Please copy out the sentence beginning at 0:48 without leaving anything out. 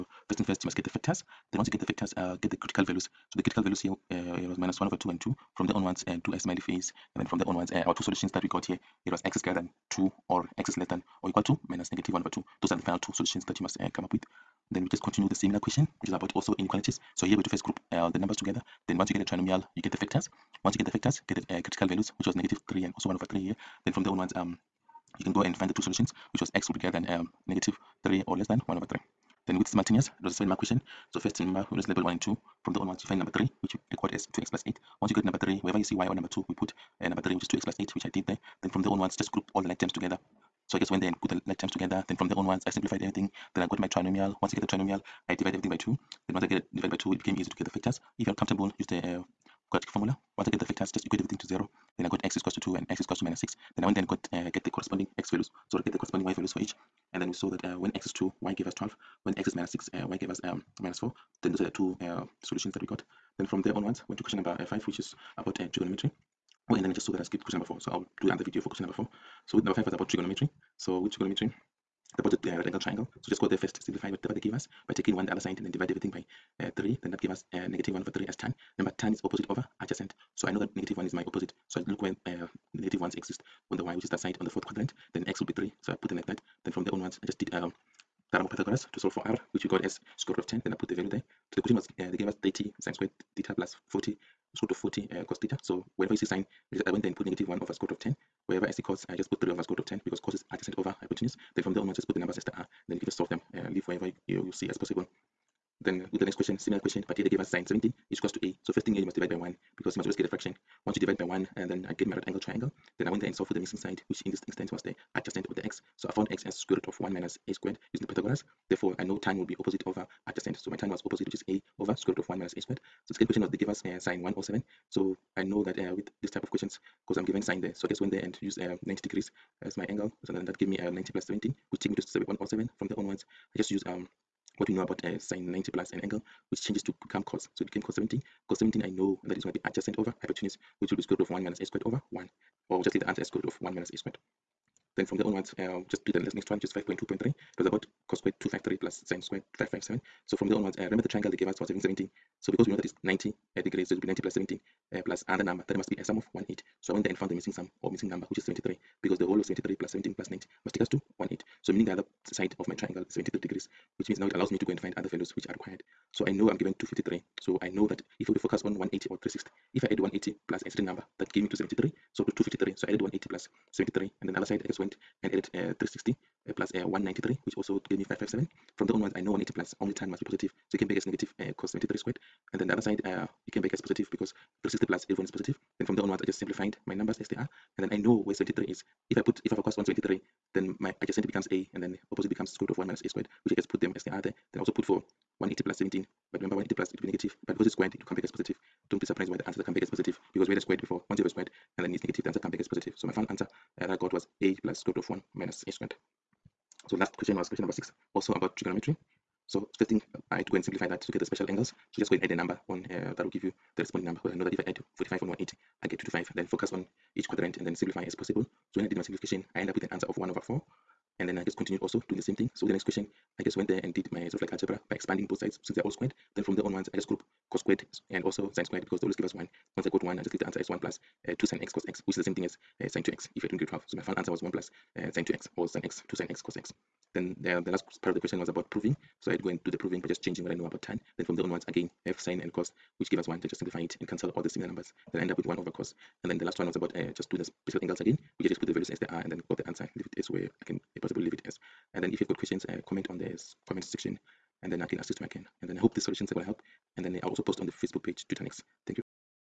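If you're comfortable, use the uh, quadratic formula.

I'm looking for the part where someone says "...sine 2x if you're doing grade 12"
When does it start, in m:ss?
3:52.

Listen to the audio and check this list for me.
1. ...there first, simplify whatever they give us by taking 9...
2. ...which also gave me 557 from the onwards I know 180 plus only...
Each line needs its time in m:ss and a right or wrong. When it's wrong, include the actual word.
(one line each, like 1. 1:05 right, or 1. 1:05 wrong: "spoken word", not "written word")
1. 1:13 wrong: "1", not "9"
2. 2:57 right.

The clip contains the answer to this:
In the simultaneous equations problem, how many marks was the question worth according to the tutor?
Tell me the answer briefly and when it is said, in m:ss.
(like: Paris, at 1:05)
7, at 0:30.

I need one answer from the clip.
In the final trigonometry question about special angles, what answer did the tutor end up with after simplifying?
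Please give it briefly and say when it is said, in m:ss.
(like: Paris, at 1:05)
1/4, at 3:40.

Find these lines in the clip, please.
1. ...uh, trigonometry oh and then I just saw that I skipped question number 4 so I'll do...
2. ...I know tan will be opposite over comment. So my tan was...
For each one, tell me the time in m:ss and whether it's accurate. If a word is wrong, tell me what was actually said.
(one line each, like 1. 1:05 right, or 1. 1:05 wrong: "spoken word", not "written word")
1. 1:05 right
2. 1:58 wrong: "adjacent", not "comment".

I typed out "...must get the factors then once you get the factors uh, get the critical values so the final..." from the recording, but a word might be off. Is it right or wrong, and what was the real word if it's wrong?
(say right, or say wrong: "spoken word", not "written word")
wrong: "critical", not "final".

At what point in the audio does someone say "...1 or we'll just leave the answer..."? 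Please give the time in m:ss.
2:22.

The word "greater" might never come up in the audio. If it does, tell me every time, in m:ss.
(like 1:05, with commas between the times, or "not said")
0:09, 0:26.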